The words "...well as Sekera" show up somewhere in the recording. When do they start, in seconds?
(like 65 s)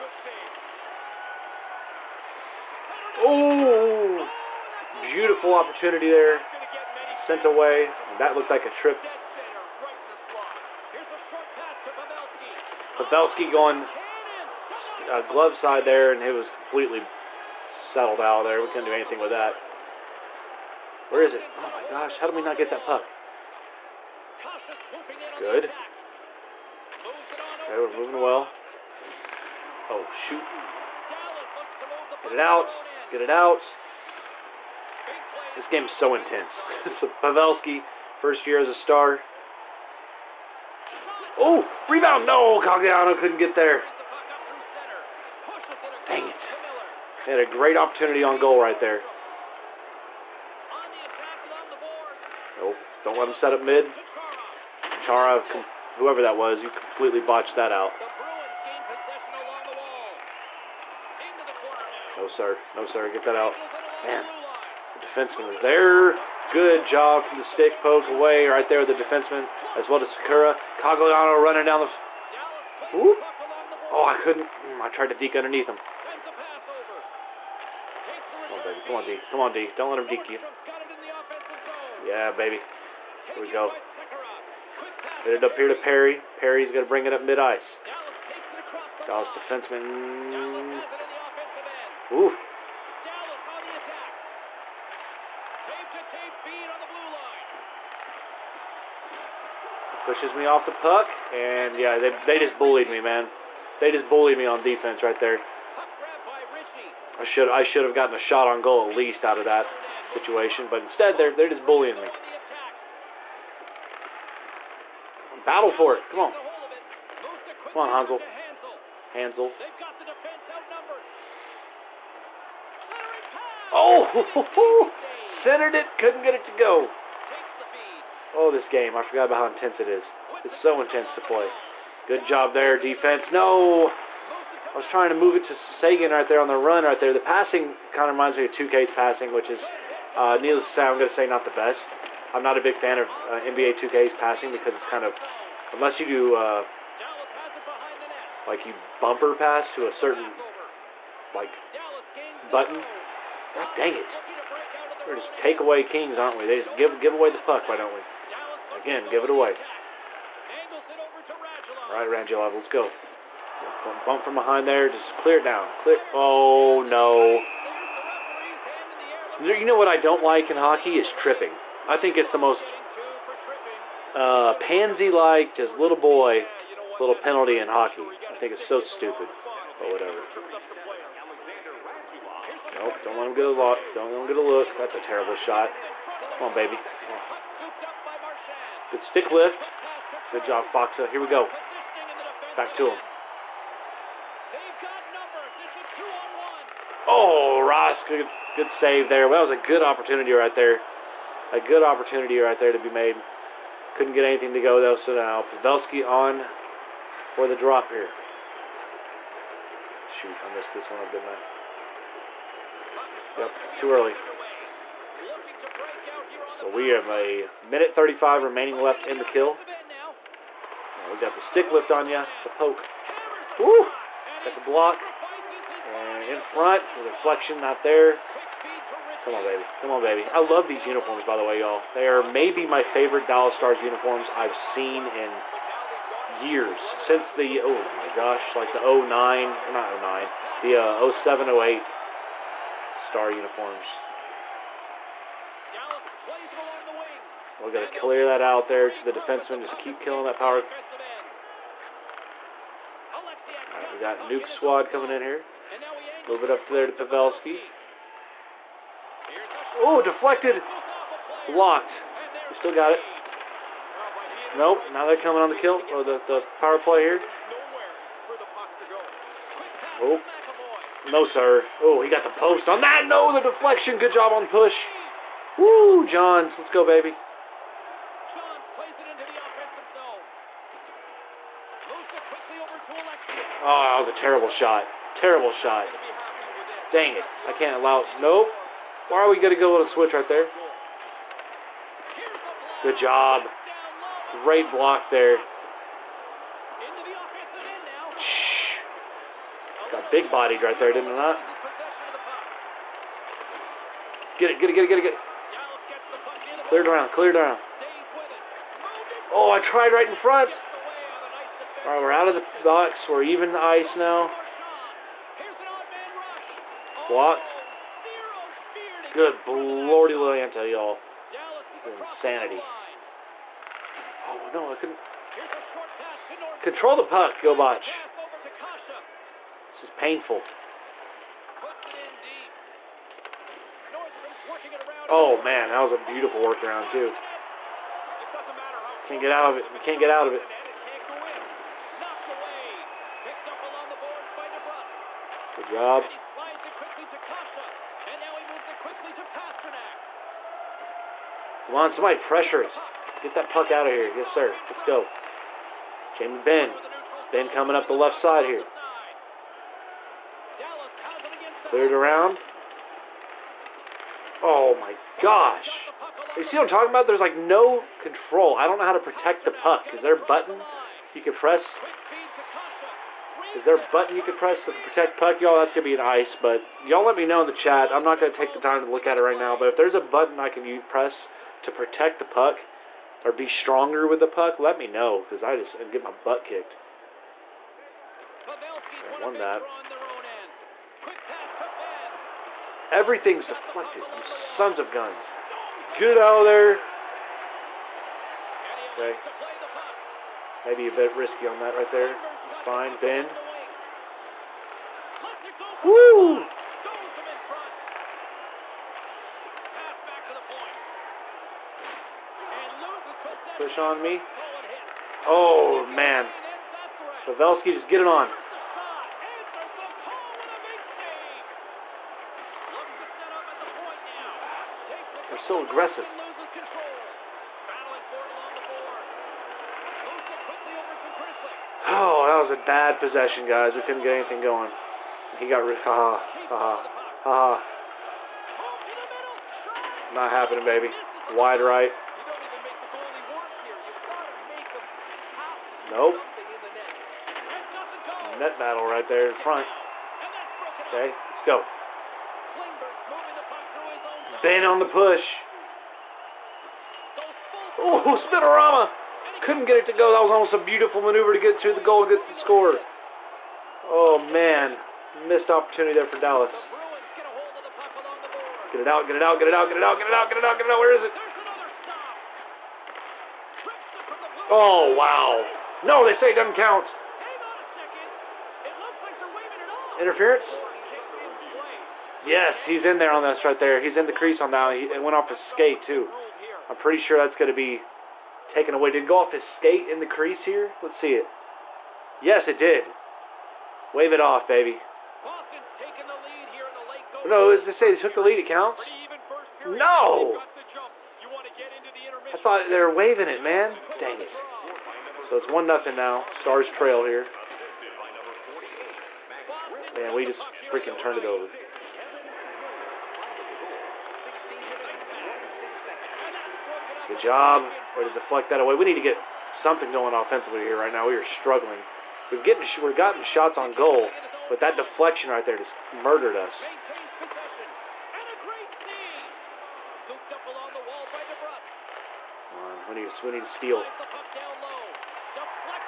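69 s.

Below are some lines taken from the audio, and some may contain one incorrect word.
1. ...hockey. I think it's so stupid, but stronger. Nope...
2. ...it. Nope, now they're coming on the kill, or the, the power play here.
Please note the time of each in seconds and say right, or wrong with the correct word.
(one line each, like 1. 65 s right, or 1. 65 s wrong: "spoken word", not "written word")
1. 177 s wrong: "whatever", not "stronger"
2. 262 s right.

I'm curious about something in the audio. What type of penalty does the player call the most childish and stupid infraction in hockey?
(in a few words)
Tripping.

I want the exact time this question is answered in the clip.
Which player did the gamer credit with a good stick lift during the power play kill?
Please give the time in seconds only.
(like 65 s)
190 s.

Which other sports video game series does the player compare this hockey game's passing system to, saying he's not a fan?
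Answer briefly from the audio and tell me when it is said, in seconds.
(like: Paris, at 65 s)
NBA 2K, at 143 s.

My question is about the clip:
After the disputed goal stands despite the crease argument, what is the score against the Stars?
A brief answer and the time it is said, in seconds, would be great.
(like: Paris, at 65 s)
1-0, at 505 s.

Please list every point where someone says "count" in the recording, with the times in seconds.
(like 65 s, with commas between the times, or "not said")
476 s, 498 s.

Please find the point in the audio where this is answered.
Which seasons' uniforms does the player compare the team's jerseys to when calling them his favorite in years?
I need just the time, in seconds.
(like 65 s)
241 s.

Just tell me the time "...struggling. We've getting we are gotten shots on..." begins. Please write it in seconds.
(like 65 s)
521 s.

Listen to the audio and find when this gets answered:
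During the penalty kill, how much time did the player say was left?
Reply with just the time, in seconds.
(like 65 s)
217 s.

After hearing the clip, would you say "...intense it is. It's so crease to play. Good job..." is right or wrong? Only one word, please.
wrong.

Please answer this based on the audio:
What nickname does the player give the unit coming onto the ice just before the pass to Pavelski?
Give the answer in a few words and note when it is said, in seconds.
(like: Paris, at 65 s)
Nuke Squad, at 254 s.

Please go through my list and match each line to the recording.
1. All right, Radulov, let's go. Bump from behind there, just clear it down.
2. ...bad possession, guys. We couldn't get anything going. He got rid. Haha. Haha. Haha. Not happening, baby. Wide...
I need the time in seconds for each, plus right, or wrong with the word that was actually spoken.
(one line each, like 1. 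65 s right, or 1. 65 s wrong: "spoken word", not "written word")
1. 161 s right
2. 432 s right.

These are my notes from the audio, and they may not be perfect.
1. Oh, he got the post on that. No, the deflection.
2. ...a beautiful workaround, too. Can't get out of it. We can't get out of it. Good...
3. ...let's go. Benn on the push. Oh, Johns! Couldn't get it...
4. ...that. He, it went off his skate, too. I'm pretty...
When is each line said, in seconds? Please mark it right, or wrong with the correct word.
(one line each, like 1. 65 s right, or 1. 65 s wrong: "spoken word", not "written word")
1. 271 s right
2. 335 s right
3. 451 s wrong: "Spinorama", not "Johns"
4. 484 s right.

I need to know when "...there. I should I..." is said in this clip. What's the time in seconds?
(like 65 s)
105 s.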